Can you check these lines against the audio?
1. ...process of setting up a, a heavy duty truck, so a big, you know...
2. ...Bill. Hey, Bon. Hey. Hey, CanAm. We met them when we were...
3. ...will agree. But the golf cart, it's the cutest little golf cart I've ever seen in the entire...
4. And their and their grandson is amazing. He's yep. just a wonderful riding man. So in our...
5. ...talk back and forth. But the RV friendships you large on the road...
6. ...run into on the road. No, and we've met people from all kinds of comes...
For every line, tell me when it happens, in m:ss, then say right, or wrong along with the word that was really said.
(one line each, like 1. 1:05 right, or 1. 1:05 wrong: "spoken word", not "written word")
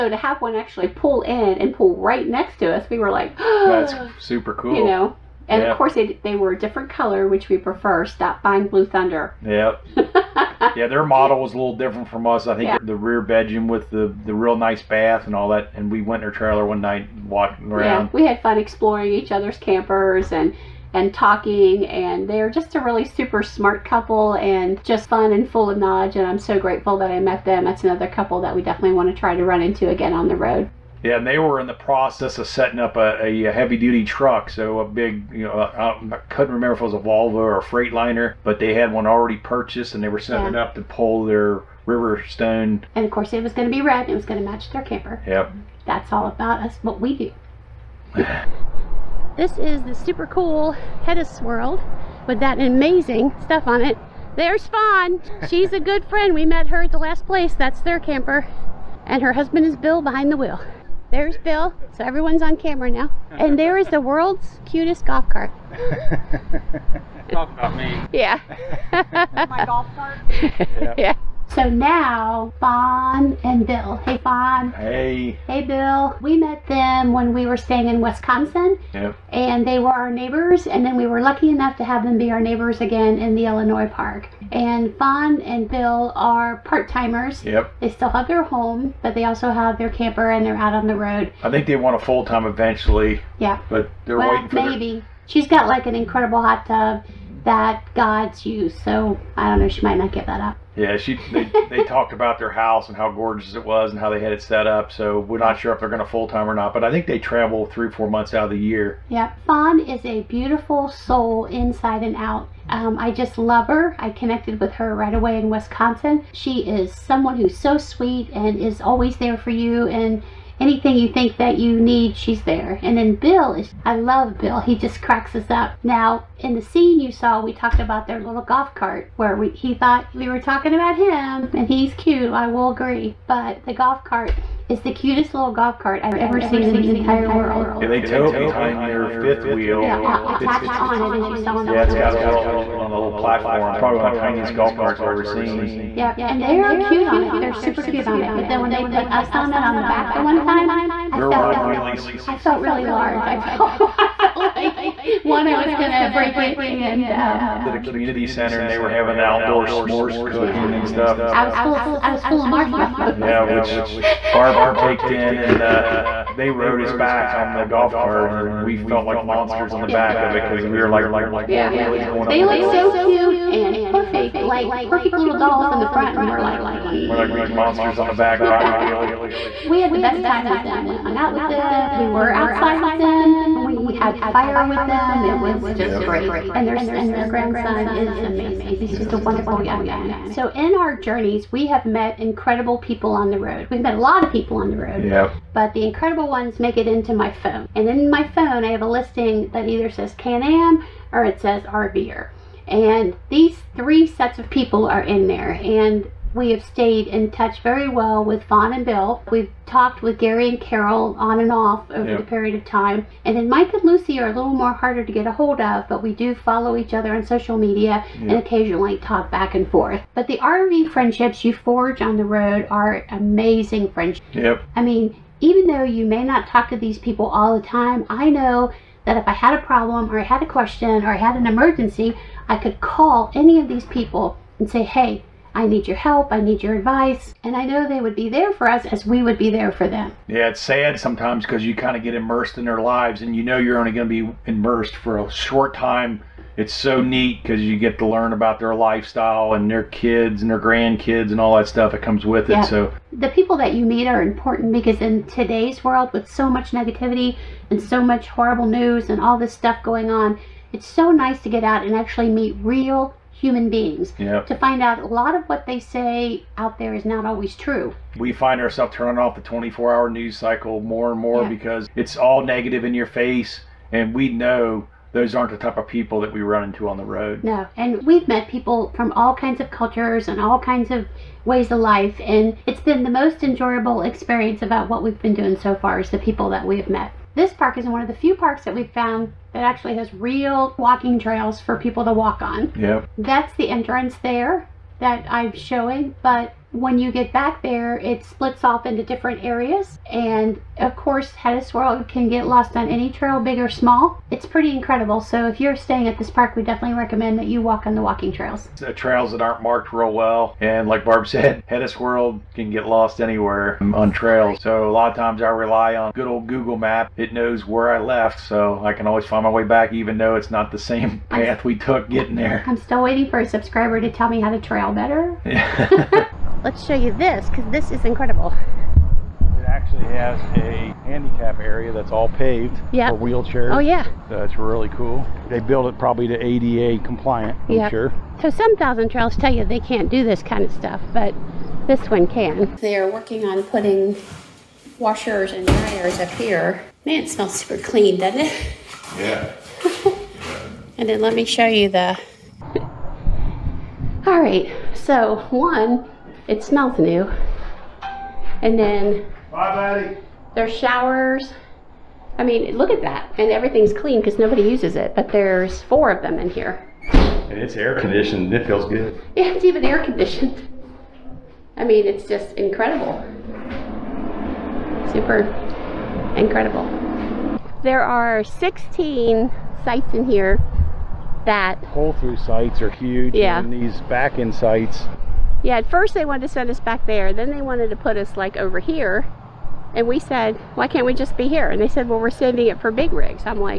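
1. 0:31 right
2. 1:13 wrong: "Bill", not "CanAm"
3. 2:12 right
4. 3:06 wrong: "young", not "riding"
5. 3:38 wrong: "forge", not "large"
6. 4:36 wrong: "cultures", not "comes".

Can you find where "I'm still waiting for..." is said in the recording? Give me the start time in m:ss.
5:22.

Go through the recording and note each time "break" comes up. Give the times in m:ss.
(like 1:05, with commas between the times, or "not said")
2:36.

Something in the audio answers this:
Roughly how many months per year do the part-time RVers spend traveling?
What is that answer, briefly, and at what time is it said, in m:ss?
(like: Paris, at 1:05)
3 to 4 months, at 1:47.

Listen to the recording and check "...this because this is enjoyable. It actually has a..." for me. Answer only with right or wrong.
wrong.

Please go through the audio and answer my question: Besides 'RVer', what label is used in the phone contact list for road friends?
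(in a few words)
Can-Am.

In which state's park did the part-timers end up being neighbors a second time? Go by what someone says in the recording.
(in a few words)
Illinois.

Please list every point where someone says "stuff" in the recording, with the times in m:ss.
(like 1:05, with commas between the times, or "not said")
0:53, 2:40, 4:11, 4:19, 5:40.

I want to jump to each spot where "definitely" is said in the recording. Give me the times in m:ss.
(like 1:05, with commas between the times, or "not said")
0:28, 5:06.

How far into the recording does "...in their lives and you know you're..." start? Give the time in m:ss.
4:02.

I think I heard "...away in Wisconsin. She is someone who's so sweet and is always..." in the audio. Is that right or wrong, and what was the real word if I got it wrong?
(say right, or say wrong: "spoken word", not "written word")
right.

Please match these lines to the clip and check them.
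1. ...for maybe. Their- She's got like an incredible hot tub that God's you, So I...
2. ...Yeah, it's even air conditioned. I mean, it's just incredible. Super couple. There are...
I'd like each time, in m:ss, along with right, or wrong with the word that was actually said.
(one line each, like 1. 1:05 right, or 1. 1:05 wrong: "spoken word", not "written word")
1. 1:34 right
2. 6:09 wrong: "incredible", not "couple".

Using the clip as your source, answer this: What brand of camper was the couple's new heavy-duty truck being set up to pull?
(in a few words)
Riverstone.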